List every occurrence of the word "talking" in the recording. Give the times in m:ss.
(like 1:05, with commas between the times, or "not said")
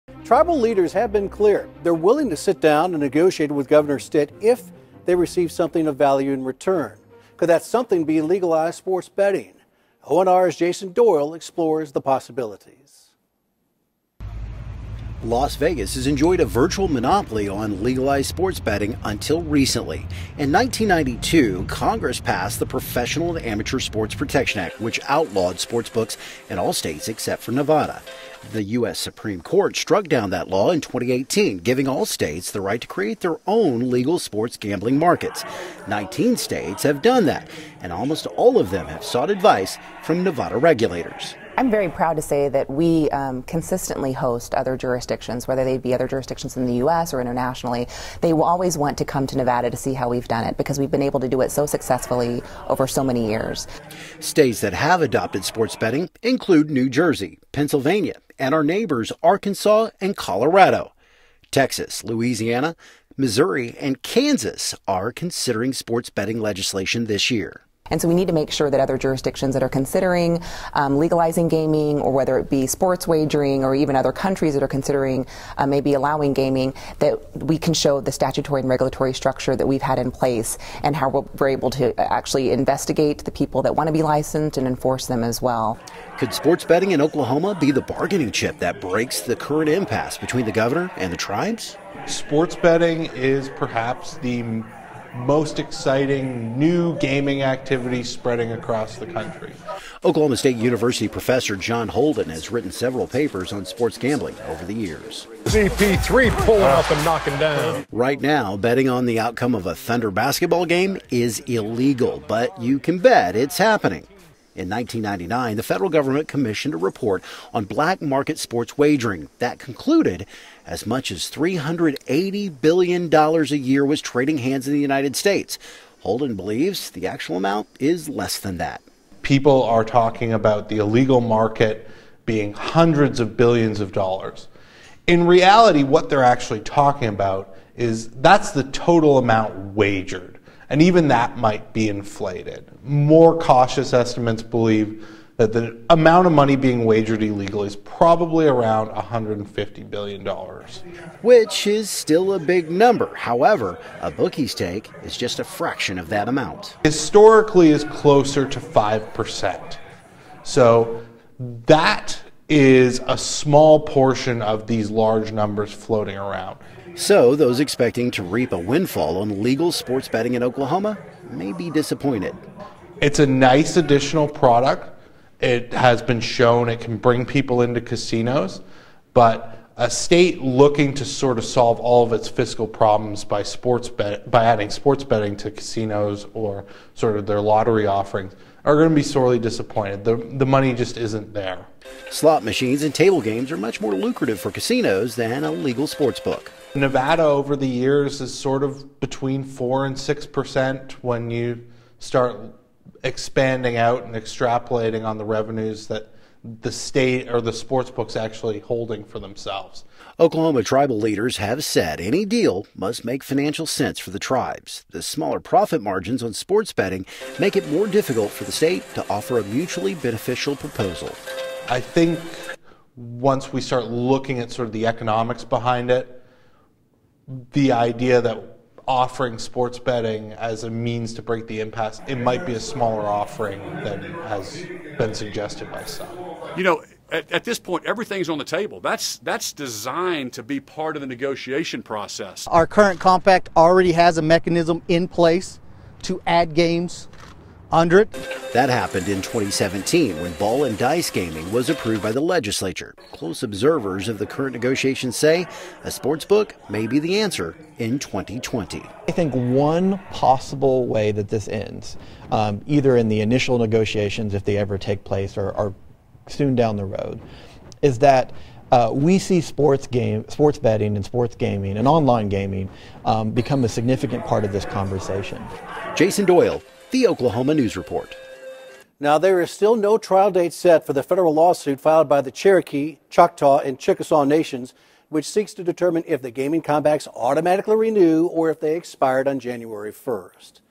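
2:09, 2:16.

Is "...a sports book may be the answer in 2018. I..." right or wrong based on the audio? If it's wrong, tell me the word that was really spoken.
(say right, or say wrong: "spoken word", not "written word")
wrong: "2020", not "2018".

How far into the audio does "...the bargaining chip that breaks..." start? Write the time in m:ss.
1:27.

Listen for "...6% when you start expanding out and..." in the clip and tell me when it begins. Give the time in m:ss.
3:19.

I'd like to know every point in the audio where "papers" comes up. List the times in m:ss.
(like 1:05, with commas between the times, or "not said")
1:43.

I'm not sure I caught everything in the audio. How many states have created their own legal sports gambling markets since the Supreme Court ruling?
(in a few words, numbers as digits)
19.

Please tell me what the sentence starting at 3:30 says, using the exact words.
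Oklahoma tribal leaders have said any deal must make financial sense for the tribes.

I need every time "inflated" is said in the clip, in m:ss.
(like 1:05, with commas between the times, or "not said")
2:21.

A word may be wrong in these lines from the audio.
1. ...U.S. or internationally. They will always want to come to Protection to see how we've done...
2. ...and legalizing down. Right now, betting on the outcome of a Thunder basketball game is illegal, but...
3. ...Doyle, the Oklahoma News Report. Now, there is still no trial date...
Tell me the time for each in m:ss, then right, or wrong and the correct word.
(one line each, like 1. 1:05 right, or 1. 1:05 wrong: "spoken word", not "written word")
1. 0:46 wrong: "Nevada", not "Protection"
2. 1:46 wrong: "knocking", not "legalizing"
3. 4:36 right.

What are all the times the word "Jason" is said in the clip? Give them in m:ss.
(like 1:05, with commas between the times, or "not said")
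0:10, 4:35.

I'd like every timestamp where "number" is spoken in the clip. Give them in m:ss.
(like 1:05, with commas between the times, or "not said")
2:32, 2:45.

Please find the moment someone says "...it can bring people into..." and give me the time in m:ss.
2:56.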